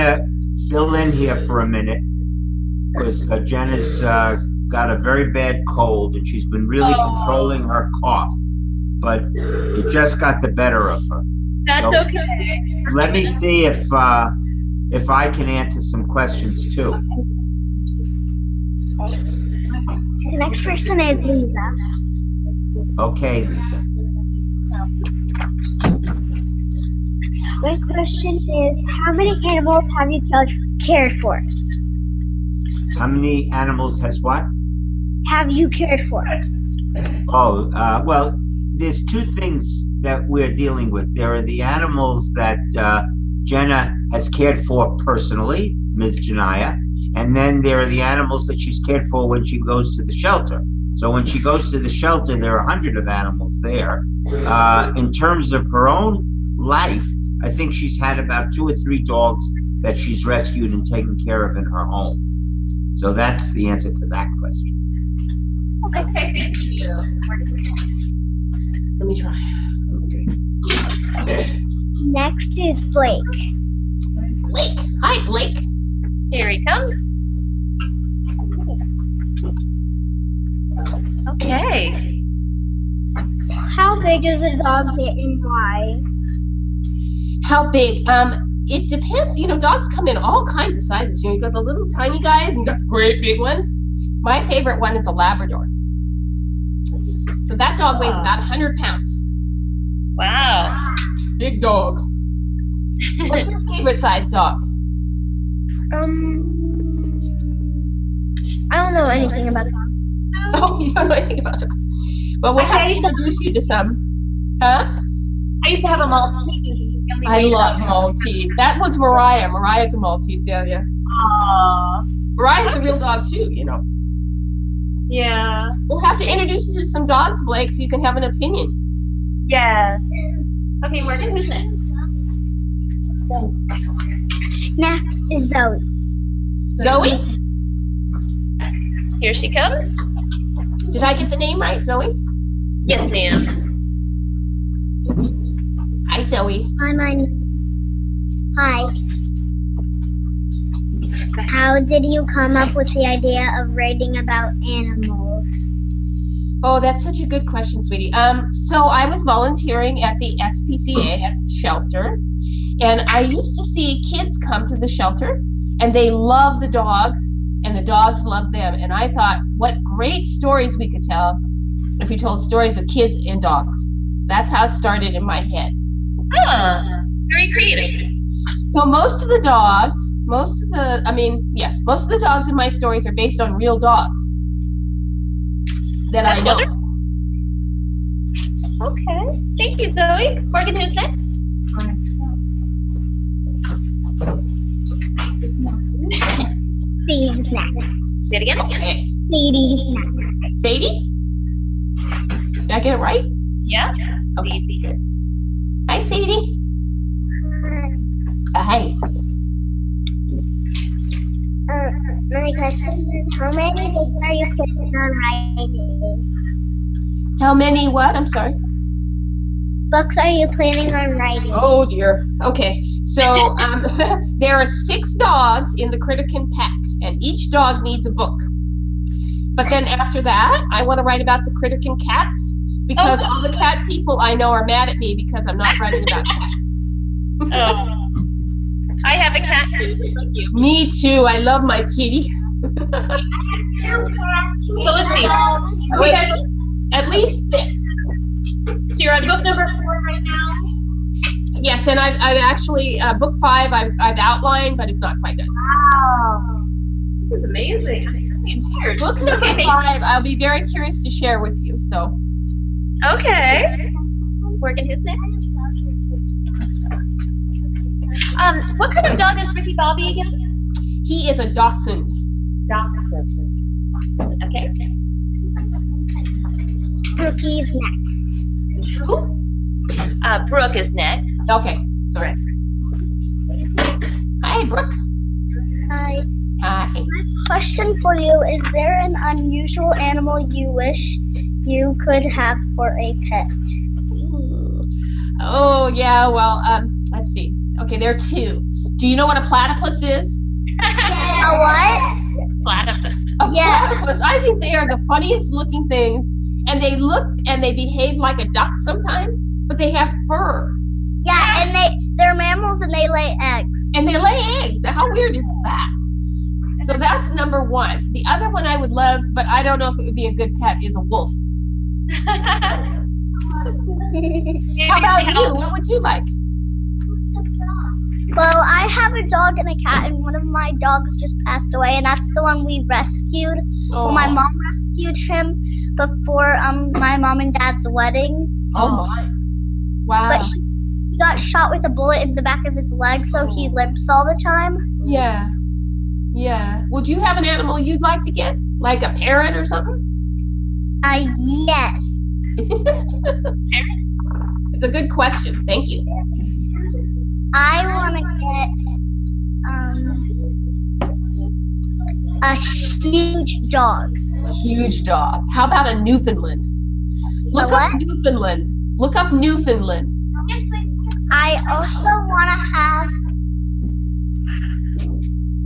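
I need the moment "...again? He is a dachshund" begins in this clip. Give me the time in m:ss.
4:30.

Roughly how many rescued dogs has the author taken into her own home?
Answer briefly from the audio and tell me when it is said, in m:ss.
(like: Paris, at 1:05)
2 or 3, at 0:58.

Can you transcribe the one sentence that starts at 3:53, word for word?
all the cat people I know are mad at me because I'm not writing about cats.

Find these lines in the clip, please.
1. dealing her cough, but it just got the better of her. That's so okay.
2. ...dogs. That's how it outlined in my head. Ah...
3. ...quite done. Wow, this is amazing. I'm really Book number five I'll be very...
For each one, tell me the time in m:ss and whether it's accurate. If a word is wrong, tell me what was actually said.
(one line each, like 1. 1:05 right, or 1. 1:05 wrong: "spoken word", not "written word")
1. 0:07 wrong: "controlling", not "dealing"
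2. 2:53 wrong: "started", not "outlined"
3. 4:15 right.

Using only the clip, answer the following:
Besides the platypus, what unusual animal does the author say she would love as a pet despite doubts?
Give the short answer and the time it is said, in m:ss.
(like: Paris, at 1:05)
Wolf, at 5:21.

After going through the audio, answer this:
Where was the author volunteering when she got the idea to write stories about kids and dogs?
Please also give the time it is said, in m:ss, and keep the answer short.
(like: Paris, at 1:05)
SPCA, at 2:40.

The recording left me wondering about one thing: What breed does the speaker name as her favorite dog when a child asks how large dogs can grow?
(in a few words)
Labrador.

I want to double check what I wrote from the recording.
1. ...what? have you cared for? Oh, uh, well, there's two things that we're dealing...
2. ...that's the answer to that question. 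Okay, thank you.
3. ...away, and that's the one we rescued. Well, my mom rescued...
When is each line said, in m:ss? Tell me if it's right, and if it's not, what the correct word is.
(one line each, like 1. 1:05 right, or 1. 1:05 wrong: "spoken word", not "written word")
1. 0:34 right
2. 1:03 right
3. 5:31 right.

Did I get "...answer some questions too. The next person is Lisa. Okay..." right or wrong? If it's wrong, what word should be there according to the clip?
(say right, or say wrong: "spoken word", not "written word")
right.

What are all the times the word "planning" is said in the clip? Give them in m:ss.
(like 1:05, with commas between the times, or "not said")
3:34, 3:40.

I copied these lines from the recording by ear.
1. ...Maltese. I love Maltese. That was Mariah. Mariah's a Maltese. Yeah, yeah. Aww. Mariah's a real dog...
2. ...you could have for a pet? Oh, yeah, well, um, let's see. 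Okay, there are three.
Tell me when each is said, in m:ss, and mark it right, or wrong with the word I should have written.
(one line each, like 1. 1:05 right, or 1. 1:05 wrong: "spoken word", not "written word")
1. 1:56 right
2. 4:51 wrong: "two", not "three".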